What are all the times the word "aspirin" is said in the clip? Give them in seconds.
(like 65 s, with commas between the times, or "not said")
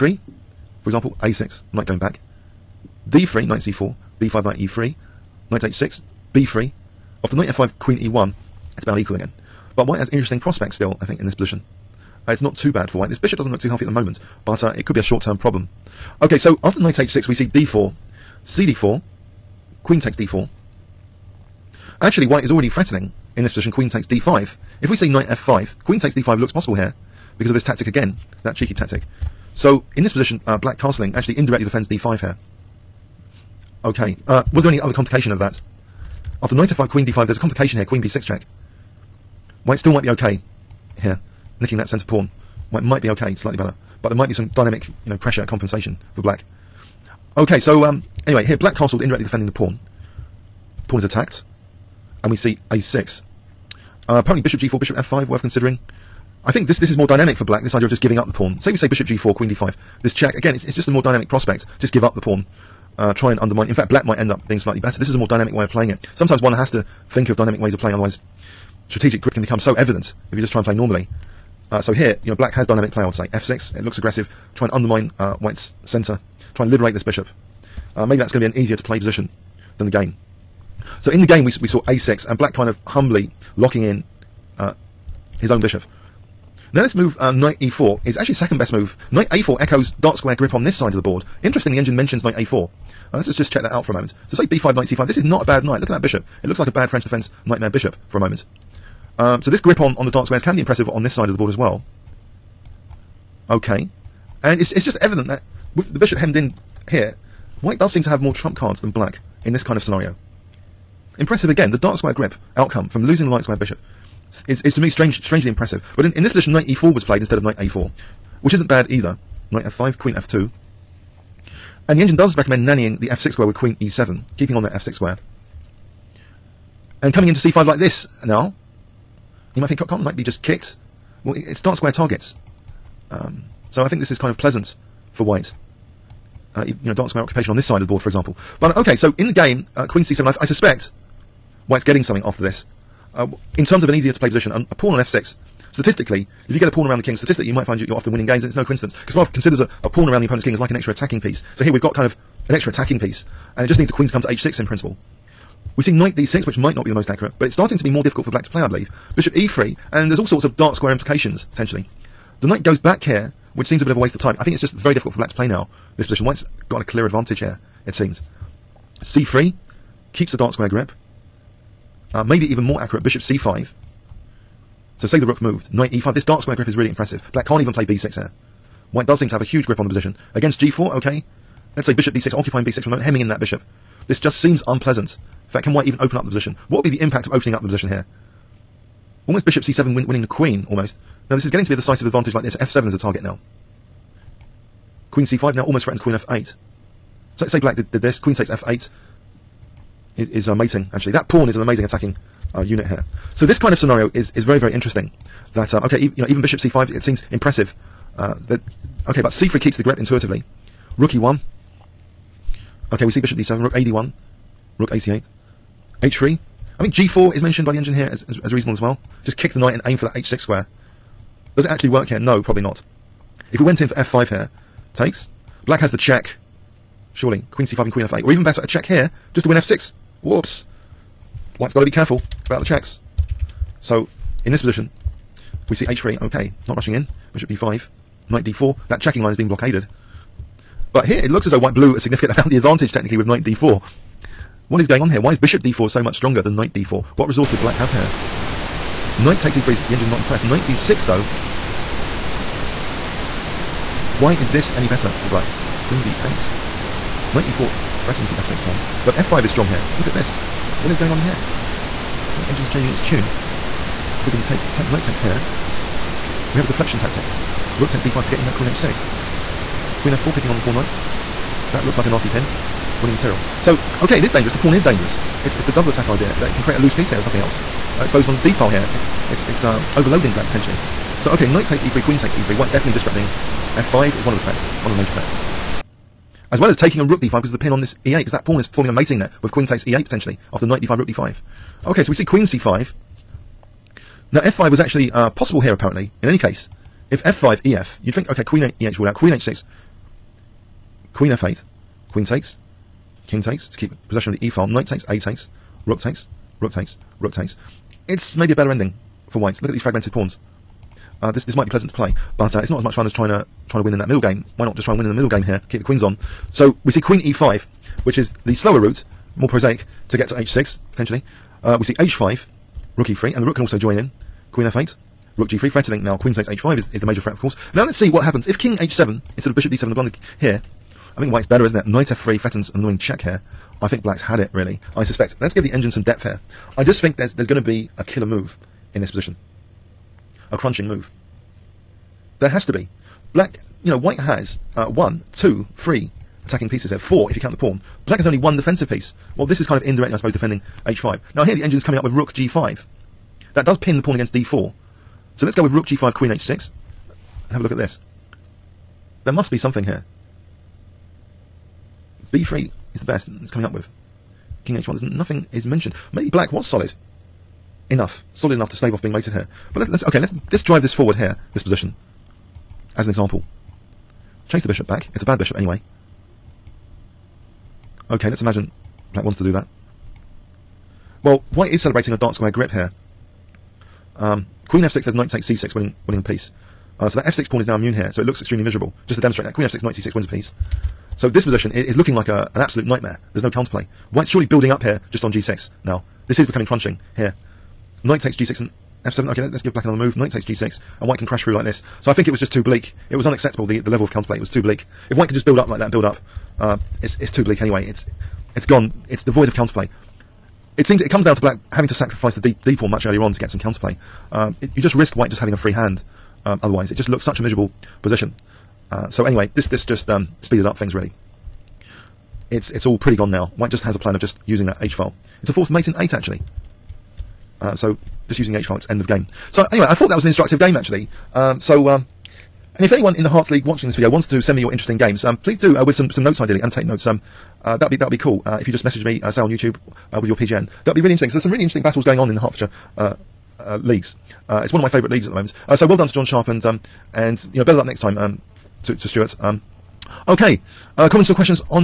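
not said.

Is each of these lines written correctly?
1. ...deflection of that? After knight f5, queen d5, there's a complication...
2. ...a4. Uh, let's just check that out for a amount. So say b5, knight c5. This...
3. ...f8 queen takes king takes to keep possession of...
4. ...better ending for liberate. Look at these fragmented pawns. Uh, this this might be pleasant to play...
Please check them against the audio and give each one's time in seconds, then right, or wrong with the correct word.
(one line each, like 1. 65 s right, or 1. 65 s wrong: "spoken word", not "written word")
1. 34 s wrong: "complication", not "deflection"
2. 92 s wrong: "moment", not "amount"
3. 301 s right
4. 308 s wrong: "white", not "liberate".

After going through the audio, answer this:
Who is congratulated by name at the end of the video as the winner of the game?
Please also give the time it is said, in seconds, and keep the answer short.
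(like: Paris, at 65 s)
John Sharp, at 446 s.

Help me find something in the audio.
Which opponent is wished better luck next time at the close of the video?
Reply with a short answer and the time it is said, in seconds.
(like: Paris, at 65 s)
Stewart, at 449 s.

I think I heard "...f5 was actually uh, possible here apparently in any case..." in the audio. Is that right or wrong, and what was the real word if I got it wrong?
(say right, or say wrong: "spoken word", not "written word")
right.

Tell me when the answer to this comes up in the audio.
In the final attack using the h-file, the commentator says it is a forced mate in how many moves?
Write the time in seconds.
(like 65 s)
425 s.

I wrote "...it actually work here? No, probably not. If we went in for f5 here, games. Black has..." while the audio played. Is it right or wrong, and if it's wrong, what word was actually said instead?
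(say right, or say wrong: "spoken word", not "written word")
wrong: "takes", not "games".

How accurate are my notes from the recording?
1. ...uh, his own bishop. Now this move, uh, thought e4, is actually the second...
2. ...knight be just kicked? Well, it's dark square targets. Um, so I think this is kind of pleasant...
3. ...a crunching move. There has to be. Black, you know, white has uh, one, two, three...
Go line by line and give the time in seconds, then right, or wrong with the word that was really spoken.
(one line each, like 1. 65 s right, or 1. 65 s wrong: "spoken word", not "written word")
1. 84 s wrong: "knight", not "thought"
2. 130 s right
3. 340 s right.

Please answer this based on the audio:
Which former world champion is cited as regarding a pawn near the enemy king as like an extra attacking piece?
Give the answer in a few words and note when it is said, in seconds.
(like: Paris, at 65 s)
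Kasparov, at 149 s.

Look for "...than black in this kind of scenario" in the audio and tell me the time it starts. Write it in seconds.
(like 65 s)
108 s.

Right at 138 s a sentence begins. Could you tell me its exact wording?
But uh, okay, so in the game, uh, Queen C7, I, I, suspect White's getting something after this.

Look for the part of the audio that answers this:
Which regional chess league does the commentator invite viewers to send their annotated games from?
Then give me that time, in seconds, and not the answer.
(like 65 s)
433 s.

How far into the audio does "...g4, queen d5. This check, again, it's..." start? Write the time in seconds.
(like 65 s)
59 s.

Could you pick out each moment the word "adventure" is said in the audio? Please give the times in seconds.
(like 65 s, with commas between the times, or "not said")
not said.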